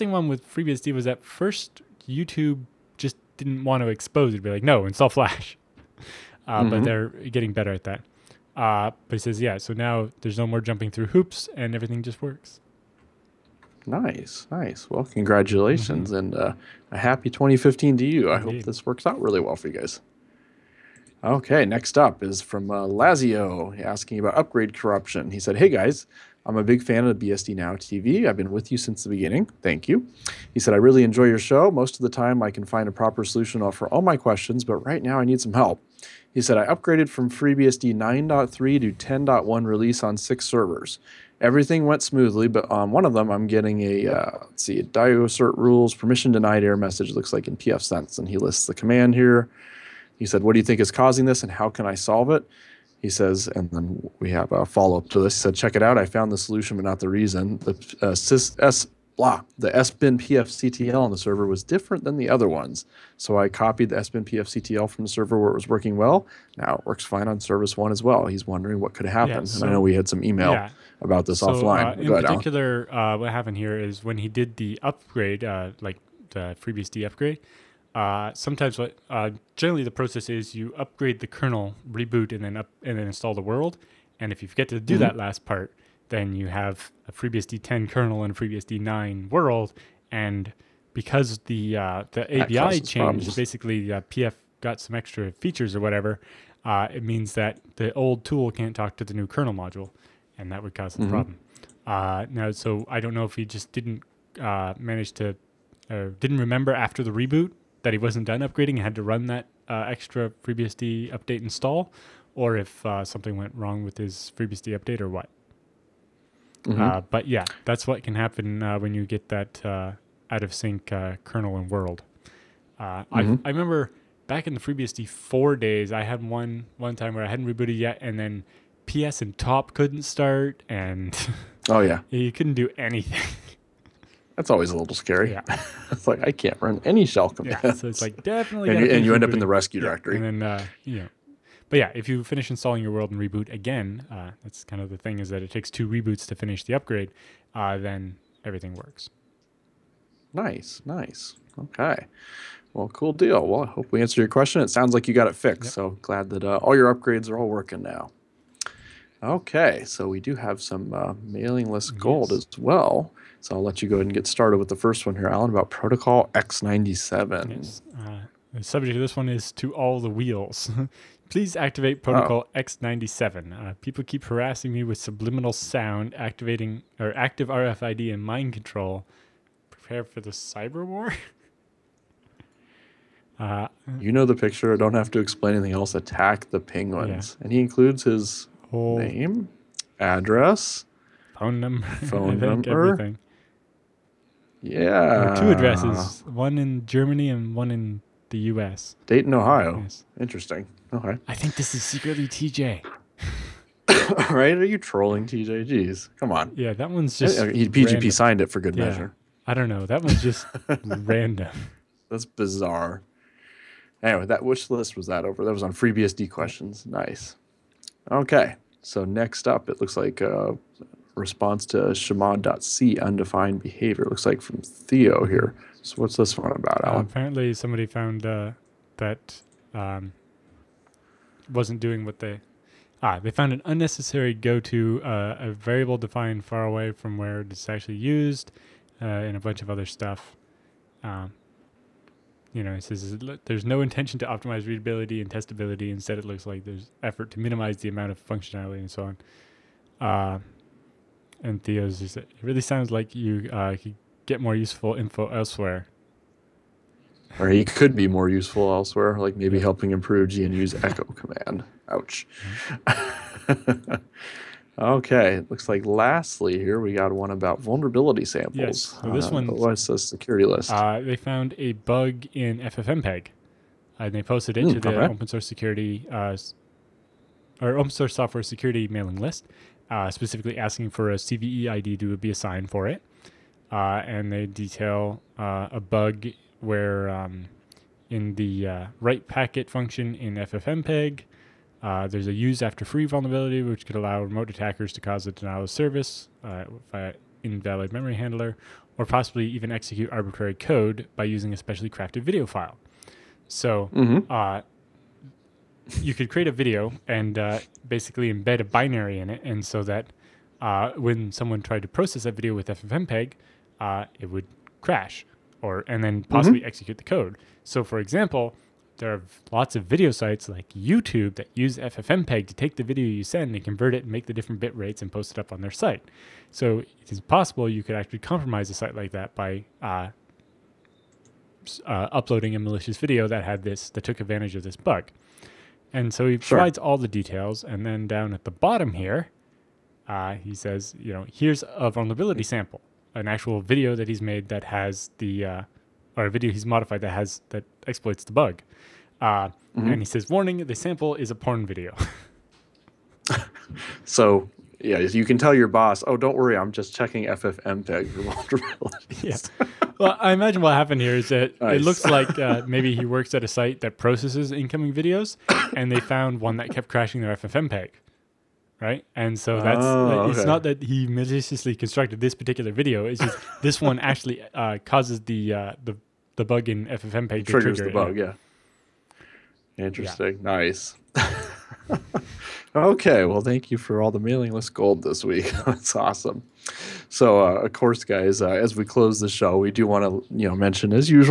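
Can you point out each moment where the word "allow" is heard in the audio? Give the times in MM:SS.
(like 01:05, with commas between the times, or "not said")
04:53.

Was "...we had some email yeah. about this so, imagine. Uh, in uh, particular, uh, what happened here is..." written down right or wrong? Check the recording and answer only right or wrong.
wrong.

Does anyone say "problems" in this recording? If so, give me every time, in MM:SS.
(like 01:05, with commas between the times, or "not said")
01:32, 01:41.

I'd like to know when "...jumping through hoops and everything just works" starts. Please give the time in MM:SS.
00:10.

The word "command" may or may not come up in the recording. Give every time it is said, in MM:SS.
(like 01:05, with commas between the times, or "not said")
00:48, 02:17, 04:21.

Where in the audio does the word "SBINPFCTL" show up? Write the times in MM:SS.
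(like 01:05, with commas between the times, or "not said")
00:59, 01:03.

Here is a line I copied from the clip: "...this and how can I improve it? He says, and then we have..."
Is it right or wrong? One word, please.
wrong.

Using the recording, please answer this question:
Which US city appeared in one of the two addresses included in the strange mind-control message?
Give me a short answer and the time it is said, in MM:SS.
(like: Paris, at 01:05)
Dayton, Ohio, at 03:19.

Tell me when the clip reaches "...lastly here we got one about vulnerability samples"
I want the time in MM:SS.
04:25.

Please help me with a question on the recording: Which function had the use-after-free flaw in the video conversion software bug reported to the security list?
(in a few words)
write packet.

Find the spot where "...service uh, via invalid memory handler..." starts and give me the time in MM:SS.
04:55.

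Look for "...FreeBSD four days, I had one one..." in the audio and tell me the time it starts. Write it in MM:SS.
02:04.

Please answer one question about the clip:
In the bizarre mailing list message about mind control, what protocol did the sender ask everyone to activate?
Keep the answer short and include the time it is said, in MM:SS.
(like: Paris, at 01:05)
Protocol X97, at 02:52.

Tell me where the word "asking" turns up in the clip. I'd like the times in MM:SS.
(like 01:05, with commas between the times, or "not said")
00:23, 04:40.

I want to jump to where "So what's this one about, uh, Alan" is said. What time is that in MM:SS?
03:45.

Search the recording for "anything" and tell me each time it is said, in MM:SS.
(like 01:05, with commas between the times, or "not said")
02:12, 03:05.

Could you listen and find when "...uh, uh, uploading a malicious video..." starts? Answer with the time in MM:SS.
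05:29.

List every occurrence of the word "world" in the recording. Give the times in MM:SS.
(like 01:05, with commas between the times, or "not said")
01:23, 01:29, 02:01, 02:22.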